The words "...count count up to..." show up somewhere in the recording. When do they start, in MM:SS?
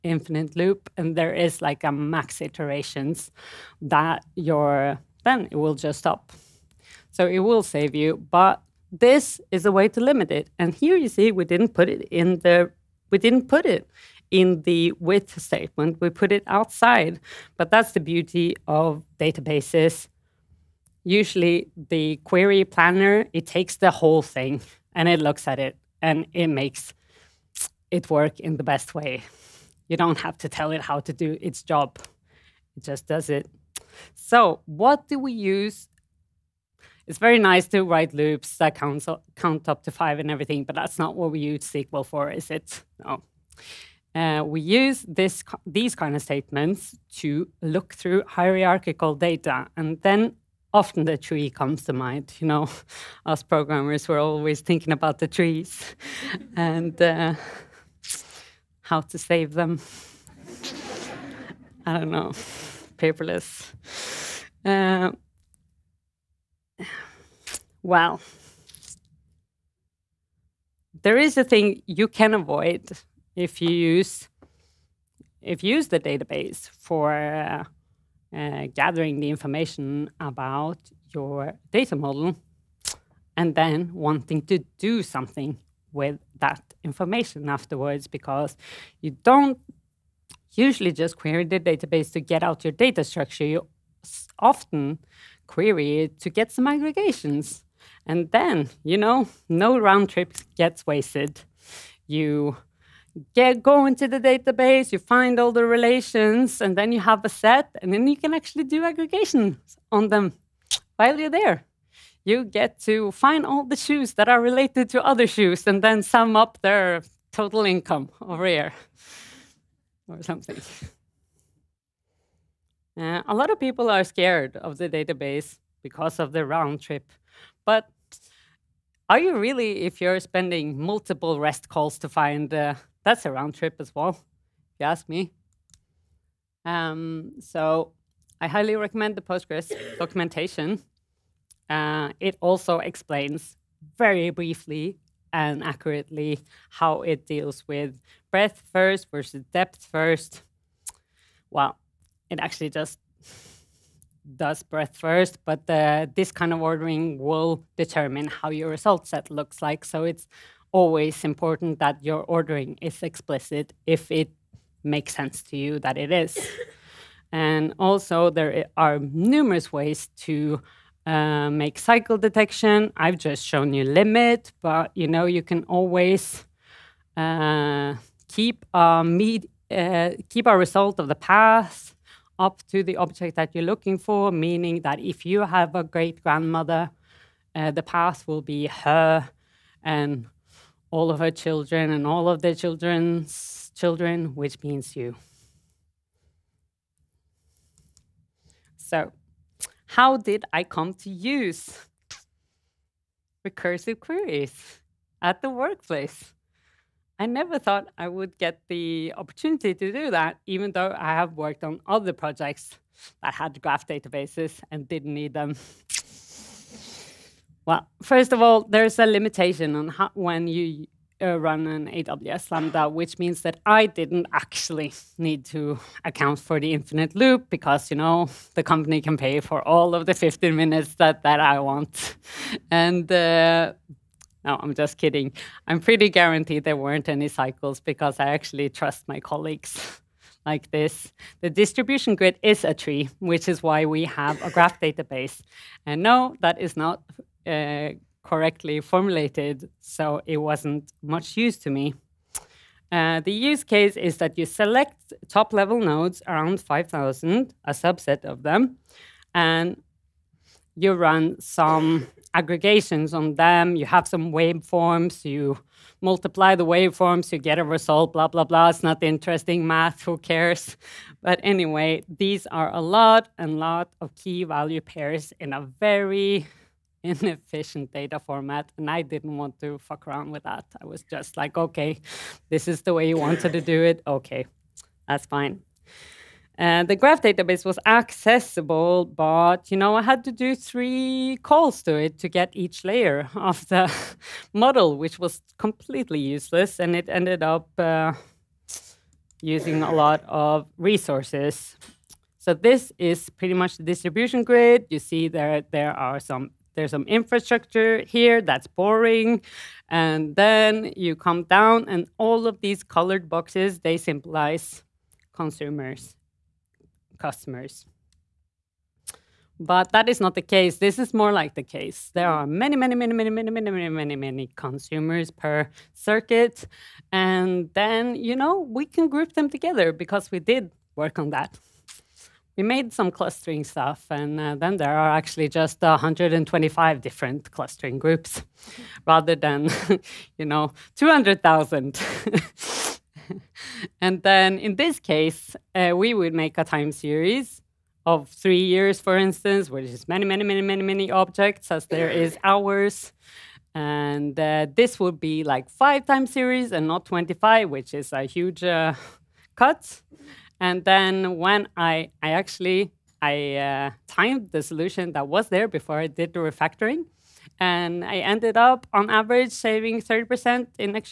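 00:38.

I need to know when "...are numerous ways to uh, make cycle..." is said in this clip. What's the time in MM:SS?
02:48.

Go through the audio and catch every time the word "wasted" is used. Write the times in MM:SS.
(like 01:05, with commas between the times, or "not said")
01:40.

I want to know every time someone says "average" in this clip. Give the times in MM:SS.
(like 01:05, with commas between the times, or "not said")
06:09.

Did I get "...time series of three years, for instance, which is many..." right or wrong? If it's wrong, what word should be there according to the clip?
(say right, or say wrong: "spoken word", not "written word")
right.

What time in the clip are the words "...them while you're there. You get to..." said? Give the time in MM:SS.
01:50.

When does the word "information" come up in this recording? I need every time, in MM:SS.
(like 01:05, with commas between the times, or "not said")
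01:19, 01:26.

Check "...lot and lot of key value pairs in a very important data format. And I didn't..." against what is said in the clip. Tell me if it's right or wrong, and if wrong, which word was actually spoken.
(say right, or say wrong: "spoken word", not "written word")
wrong: "inefficient", not "important".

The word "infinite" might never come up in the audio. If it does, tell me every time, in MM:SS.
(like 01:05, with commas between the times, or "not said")
00:00, 03:46.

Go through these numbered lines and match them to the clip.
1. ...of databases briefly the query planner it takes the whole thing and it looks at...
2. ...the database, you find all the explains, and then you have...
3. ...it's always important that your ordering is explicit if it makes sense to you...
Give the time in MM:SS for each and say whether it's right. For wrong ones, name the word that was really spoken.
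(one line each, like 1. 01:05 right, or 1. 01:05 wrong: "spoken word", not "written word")
1. 00:18 wrong: "usually", not "briefly"
2. 01:44 wrong: "relations", not "explains"
3. 02:40 right.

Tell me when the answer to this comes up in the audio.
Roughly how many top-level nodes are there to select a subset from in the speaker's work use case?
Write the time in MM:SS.
04:16.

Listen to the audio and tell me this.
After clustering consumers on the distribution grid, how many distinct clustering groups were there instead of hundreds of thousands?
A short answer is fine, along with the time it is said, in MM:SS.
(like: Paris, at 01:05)
125, at 05:35.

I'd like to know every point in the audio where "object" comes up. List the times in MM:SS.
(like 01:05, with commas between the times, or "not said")
03:02, 05:51.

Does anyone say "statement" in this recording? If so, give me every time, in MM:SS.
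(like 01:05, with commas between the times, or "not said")
00:15, 00:46.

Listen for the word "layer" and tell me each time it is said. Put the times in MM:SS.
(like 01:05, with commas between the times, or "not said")
04:52.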